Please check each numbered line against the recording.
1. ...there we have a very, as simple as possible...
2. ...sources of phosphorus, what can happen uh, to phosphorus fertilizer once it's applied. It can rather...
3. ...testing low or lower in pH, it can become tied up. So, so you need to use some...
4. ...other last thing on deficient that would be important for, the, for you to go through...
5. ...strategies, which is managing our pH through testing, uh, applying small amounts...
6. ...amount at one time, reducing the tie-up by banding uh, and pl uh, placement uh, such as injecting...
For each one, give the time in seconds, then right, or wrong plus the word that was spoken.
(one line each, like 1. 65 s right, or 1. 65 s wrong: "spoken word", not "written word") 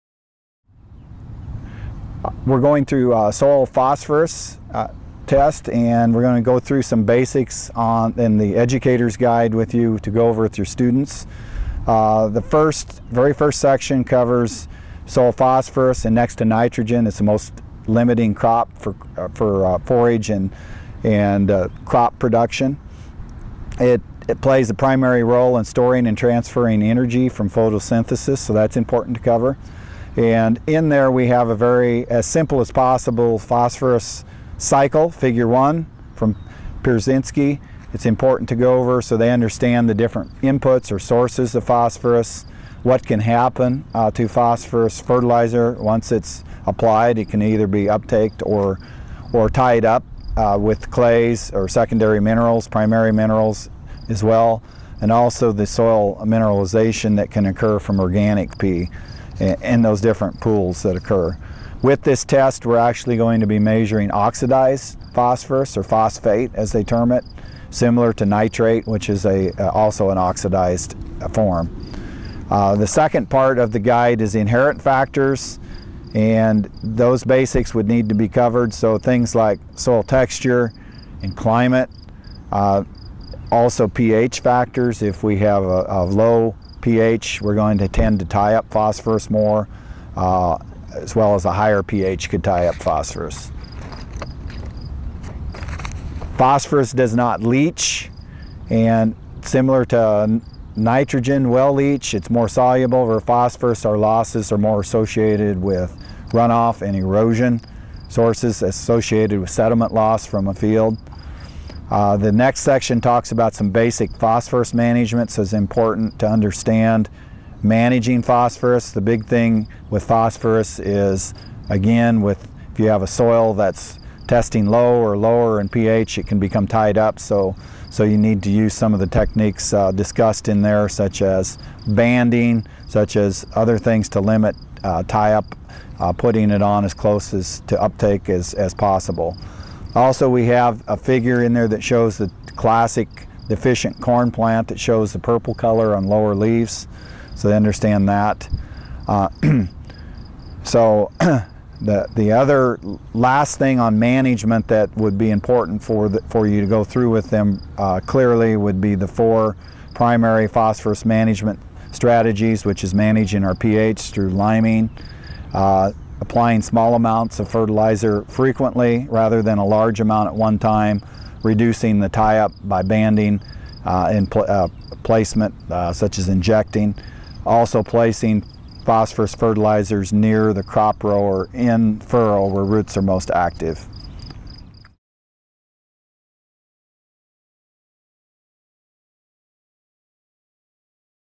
1. 30 s right
2. 40 s wrong: "either", not "rather"
3. 124 s right
4. 152 s wrong: "management", not "deficient"
5. 161 s wrong: "liming", not "testing"
6. 169 s right.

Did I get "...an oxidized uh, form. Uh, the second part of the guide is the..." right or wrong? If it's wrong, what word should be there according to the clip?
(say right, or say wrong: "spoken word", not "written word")
right.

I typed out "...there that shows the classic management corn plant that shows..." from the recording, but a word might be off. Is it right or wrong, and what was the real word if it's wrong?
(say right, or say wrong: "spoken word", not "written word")
wrong: "deficient", not "management".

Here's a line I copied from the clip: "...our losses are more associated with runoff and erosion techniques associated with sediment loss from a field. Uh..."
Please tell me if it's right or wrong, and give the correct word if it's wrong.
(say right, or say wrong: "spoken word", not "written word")
wrong: "sources", not "techniques".